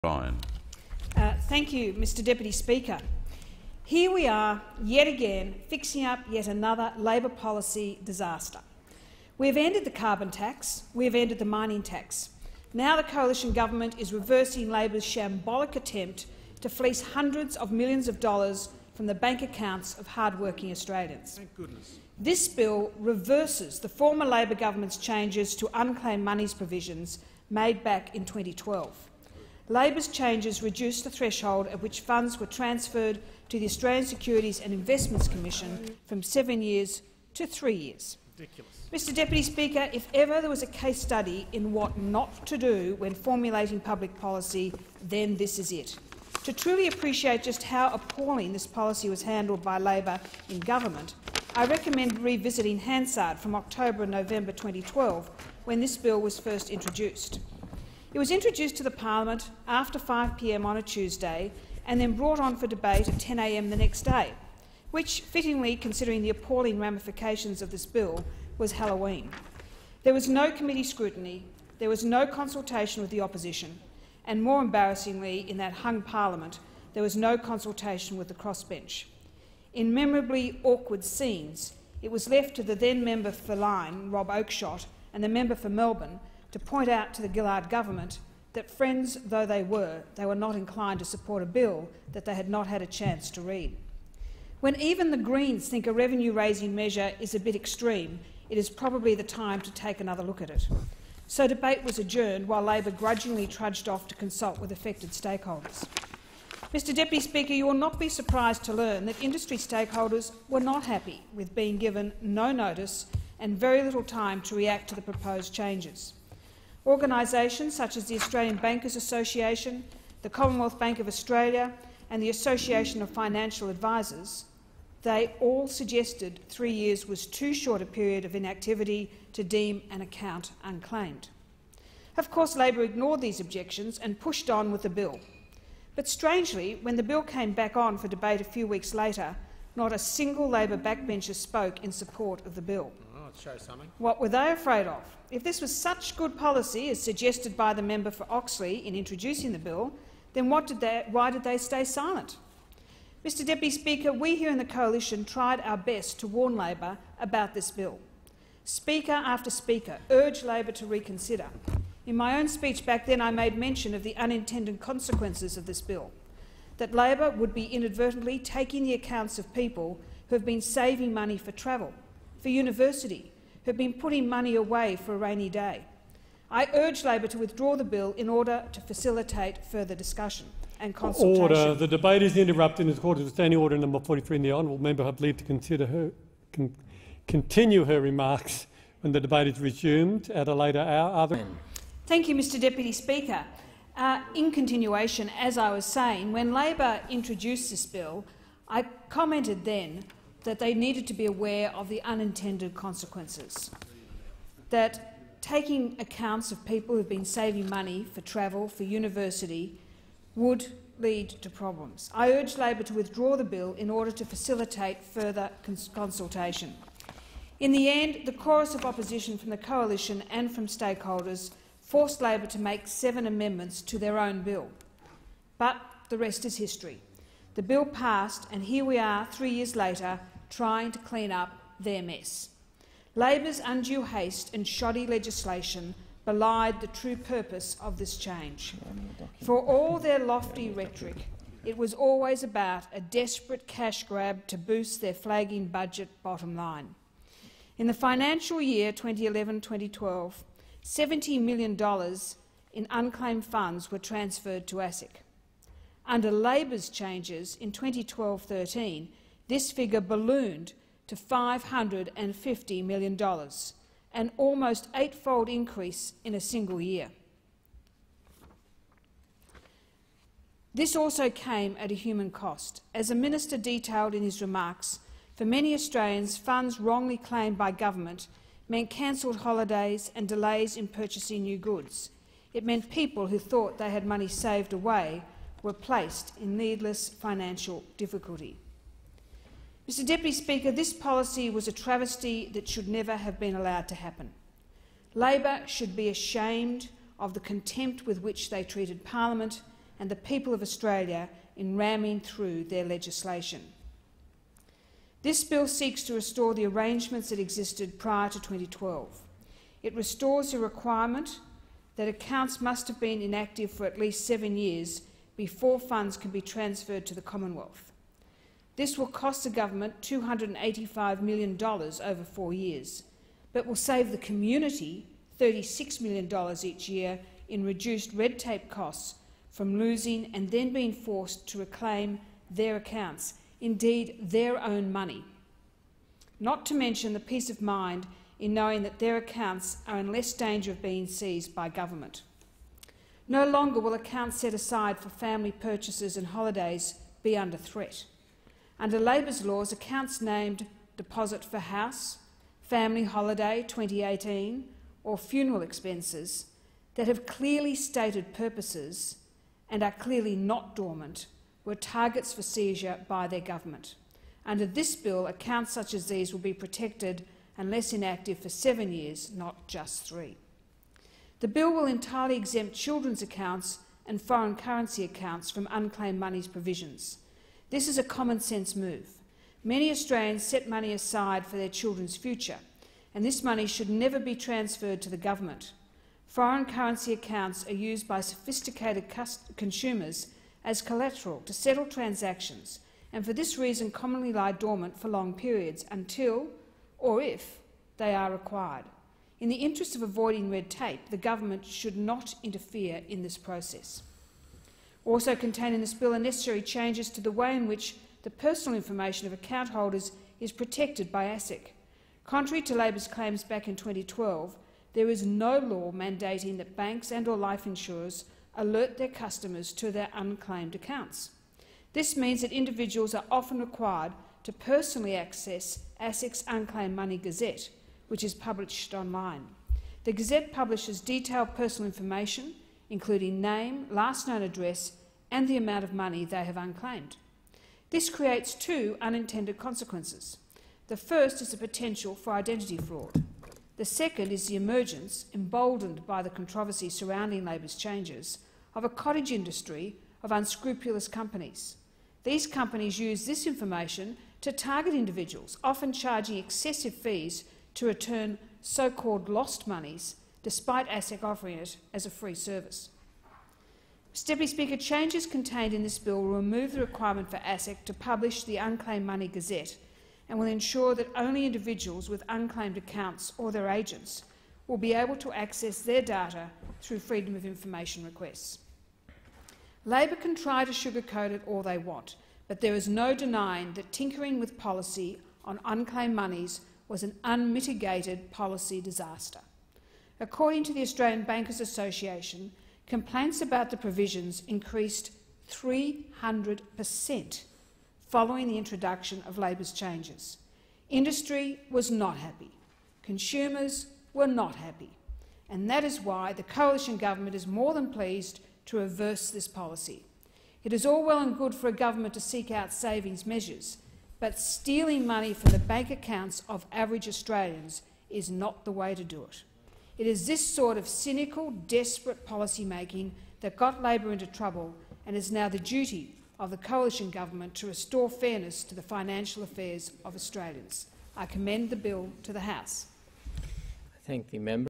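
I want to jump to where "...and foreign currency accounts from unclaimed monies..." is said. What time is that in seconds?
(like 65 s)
374 s.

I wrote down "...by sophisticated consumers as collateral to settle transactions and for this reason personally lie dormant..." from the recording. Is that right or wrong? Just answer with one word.
wrong.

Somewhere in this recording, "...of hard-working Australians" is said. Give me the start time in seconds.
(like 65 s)
19 s.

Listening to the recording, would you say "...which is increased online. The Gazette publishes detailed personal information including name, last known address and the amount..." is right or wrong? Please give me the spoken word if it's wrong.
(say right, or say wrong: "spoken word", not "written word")
wrong: "published", not "increased".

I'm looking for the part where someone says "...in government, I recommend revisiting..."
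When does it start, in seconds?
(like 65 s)
50 s.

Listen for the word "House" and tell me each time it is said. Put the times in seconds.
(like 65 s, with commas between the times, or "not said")
351 s, 532 s.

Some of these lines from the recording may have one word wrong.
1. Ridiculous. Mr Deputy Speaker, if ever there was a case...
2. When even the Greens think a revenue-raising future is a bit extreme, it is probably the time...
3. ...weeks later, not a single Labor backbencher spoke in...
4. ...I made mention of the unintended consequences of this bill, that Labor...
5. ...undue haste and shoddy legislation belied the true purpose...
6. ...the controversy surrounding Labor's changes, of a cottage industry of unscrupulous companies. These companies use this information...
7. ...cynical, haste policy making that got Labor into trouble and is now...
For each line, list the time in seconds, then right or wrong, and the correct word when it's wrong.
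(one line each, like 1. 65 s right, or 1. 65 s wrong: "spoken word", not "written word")
1. 38 s right
2. 94 s wrong: "measure", not "future"
3. 138 s right
4. 163 s right
5. 233 s right
6. 446 s right
7. 520 s wrong: "desperate", not "haste".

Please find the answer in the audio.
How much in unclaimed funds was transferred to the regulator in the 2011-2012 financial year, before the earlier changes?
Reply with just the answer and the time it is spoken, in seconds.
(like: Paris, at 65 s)
$70 million, at 250 s.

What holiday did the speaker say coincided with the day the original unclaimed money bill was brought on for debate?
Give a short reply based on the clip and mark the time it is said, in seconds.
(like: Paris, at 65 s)
Halloween, at 68 s.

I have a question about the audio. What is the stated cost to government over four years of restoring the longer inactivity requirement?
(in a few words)
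$285 million.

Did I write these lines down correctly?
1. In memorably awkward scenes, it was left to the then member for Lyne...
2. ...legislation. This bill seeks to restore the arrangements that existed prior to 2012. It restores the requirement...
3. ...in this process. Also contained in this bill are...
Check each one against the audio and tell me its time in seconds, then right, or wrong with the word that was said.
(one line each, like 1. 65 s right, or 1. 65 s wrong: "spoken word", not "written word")
1. 79 s right
2. 302 s right
3. 403 s right.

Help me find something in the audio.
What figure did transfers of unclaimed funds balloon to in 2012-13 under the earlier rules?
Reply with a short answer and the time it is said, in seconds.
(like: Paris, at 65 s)
$550 million, at 261 s.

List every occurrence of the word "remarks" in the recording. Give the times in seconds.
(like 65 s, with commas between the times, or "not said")
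188 s, 274 s.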